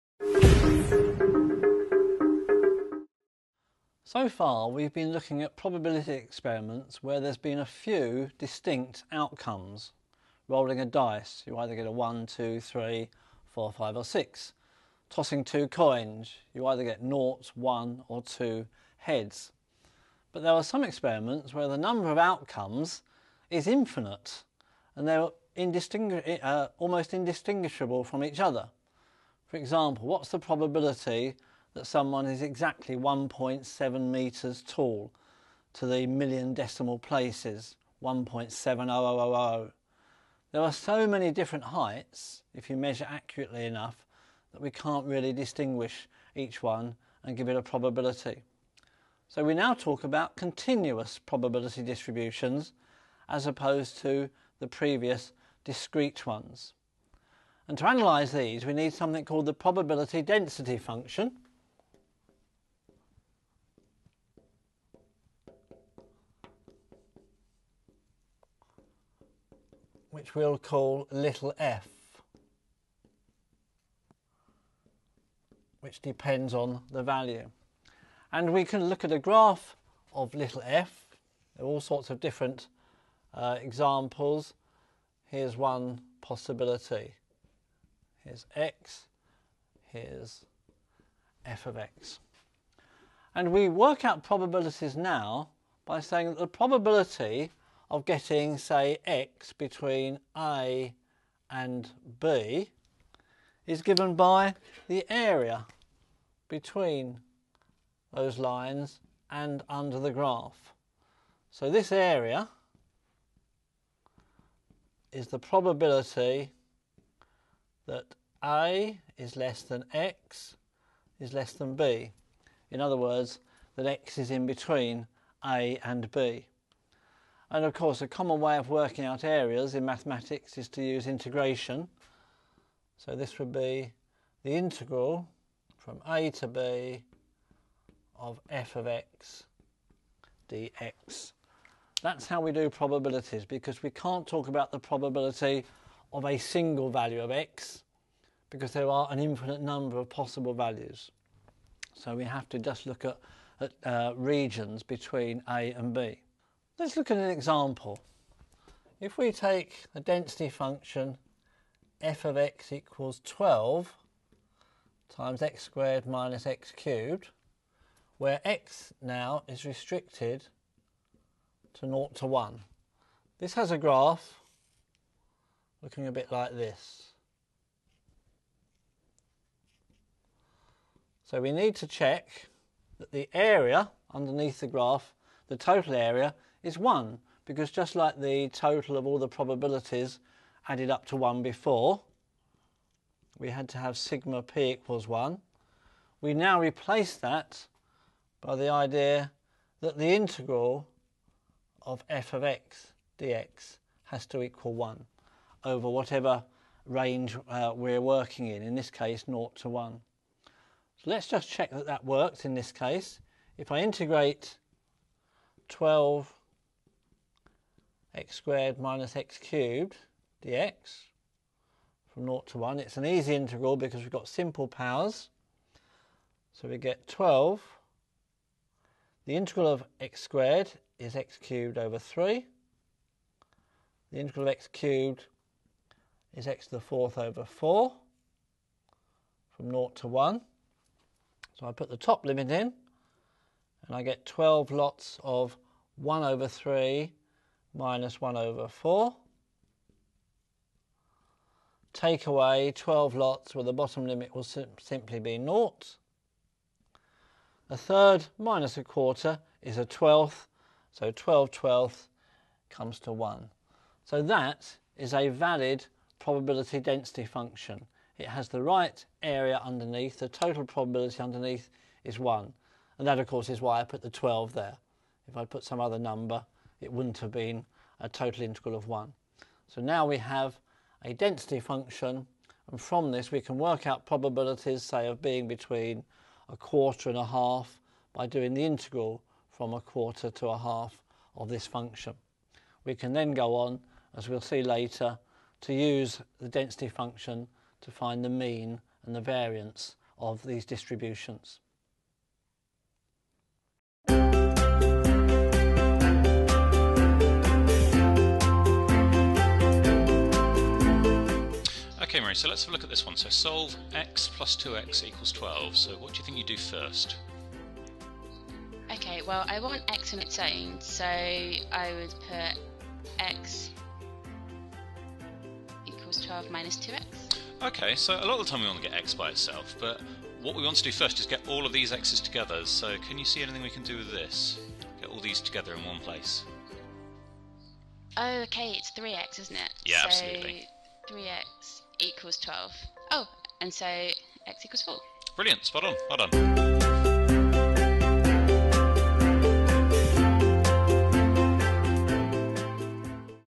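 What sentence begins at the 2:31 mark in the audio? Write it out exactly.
So we have to just look at, at uh, regions between a and b.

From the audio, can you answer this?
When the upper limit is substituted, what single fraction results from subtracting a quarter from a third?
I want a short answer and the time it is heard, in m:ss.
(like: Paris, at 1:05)
a twelfth, at 4:19.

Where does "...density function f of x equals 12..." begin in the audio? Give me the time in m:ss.
2:39.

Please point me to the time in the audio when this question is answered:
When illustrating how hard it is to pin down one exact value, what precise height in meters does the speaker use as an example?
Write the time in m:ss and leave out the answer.
0:32.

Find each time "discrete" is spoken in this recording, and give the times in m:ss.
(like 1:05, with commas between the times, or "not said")
0:55.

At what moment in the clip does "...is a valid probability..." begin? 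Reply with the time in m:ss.
4:24.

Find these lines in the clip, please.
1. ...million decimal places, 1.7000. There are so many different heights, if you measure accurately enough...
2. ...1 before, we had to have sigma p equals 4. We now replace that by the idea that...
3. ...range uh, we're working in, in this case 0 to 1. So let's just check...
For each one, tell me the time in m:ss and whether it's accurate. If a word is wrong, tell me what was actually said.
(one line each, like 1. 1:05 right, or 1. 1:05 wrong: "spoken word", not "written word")
1. 0:36 right
2. 3:11 wrong: "1", not "4"
3. 3:26 right.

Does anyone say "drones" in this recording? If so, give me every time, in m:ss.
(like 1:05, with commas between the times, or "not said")
not said.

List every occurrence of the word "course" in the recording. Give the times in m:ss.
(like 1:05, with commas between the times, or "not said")
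2:07, 4:33.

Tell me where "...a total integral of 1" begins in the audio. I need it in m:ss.
4:37.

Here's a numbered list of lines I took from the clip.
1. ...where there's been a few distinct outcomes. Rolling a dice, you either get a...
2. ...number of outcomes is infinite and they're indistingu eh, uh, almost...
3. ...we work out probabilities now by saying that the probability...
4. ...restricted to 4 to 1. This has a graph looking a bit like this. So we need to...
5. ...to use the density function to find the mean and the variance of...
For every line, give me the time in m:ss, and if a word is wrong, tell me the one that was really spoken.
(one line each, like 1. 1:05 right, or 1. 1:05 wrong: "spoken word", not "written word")
1. 0:07 right
2. 0:21 right
3. 1:33 right
4. 2:49 wrong: "0", not "4"
5. 4:55 right.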